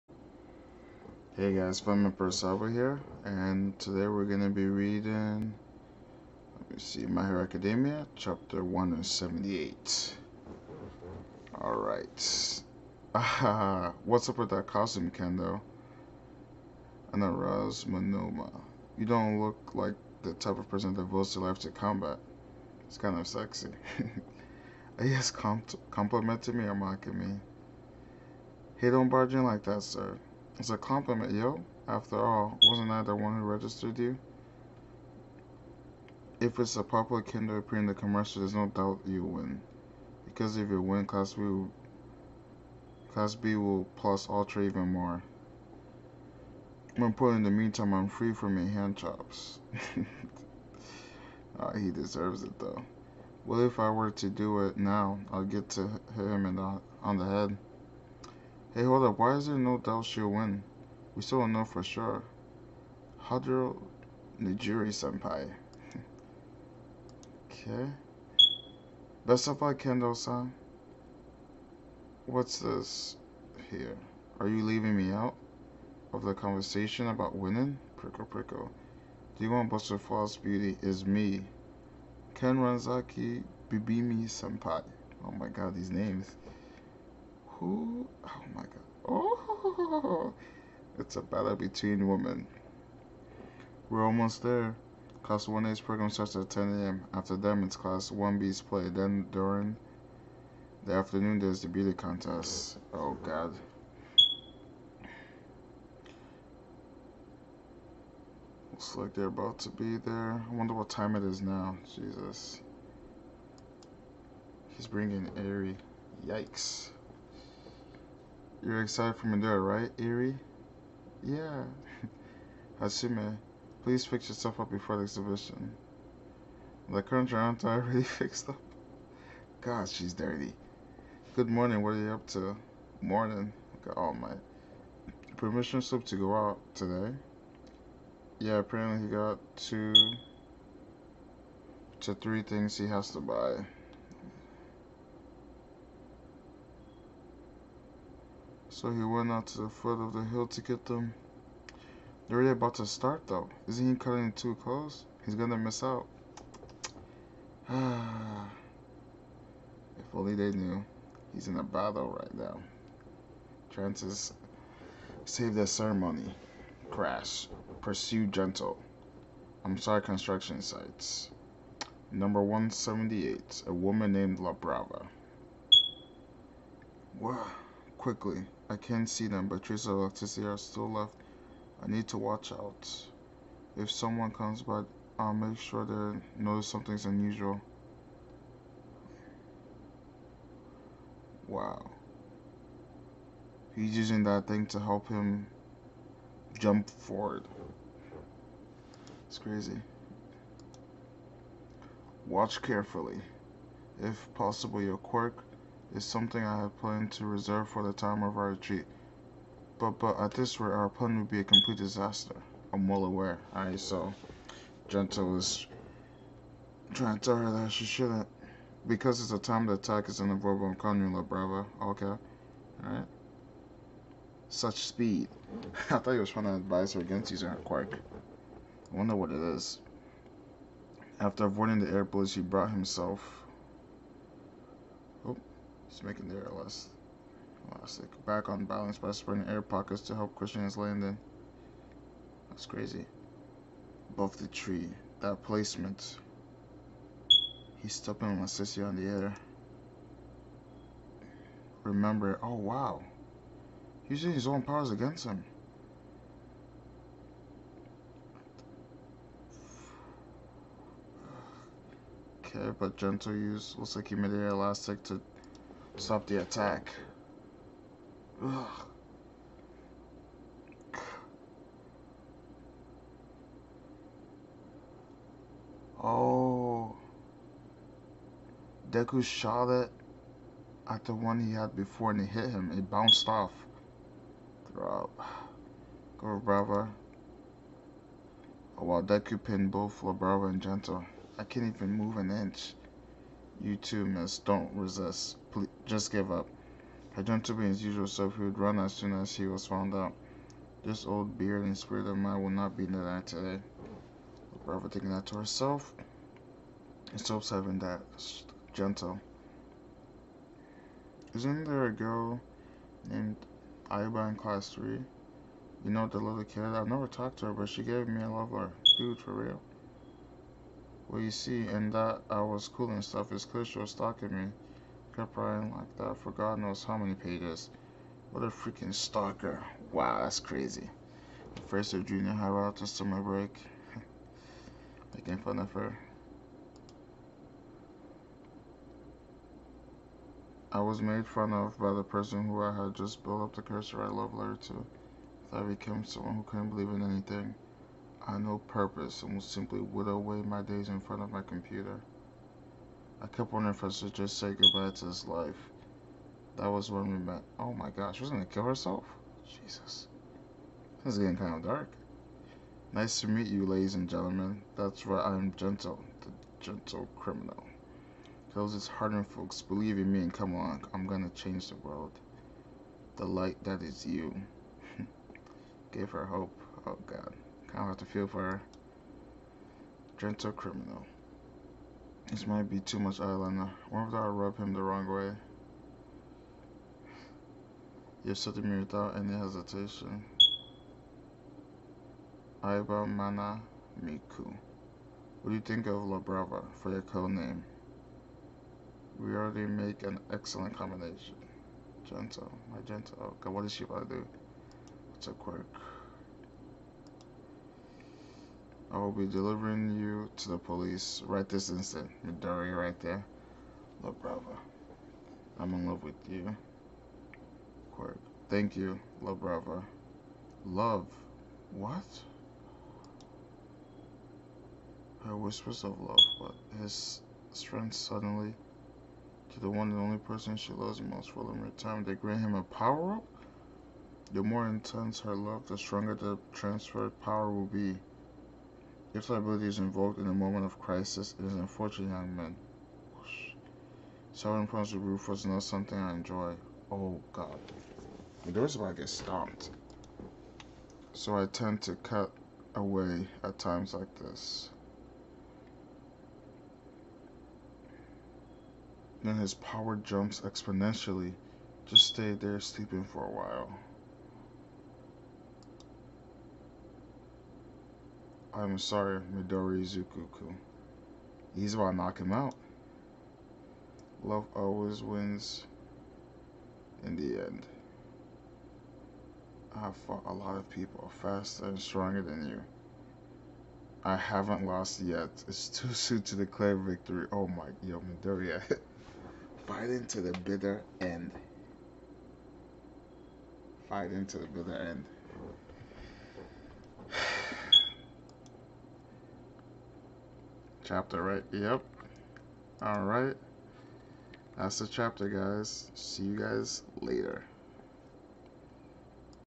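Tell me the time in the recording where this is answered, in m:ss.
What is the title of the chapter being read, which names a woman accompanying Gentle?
2:53.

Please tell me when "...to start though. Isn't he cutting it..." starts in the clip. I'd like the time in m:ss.
2:32.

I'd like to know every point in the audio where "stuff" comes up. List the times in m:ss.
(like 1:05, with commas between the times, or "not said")
5:23.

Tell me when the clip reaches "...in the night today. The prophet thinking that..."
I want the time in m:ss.
5:02.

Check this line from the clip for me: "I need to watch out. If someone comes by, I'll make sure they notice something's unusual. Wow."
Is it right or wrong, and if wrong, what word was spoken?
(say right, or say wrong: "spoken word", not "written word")
right.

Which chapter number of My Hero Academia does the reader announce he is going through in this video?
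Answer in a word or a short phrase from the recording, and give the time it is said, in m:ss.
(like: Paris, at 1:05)
178, at 0:08.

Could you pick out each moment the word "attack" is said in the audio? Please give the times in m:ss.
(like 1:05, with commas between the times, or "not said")
3:39, 4:26.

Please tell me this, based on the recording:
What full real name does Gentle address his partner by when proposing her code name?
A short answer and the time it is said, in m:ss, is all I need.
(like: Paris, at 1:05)
Aiba Mana Miku, at 6:32.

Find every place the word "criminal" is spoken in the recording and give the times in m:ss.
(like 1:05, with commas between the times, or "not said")
6:07, 6:20.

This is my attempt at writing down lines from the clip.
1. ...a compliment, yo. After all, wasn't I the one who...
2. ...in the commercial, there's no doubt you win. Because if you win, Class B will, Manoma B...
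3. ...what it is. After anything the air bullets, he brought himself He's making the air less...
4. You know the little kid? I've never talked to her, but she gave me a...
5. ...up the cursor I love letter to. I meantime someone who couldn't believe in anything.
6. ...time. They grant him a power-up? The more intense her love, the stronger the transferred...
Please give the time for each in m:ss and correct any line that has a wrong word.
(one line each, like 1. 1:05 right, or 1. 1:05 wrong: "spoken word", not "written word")
1. 0:30 right
2. 0:37 wrong: "Class", not "Manoma"
3. 3:49 wrong: "avoiding", not "anything"
4. 5:15 right
5. 5:43 wrong: "became", not "meantime"
6. 7:11 right.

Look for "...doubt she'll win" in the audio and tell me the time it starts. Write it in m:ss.
0:59.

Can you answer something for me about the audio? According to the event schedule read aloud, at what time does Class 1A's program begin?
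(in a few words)
10 a.m.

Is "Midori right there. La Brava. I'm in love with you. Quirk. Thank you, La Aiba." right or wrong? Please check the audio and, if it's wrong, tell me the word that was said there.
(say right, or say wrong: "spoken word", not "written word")
wrong: "Brava", not "Aiba".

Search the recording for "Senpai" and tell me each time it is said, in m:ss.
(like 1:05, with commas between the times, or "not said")
1:04, 1:24.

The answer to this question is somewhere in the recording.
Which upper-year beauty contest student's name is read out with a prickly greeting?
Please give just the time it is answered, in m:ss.
1:22.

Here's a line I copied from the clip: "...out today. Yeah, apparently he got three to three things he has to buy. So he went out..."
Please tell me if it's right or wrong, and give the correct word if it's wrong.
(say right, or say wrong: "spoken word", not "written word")
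wrong: "two", not "three".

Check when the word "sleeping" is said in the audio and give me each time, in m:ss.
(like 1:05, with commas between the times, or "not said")
7:42.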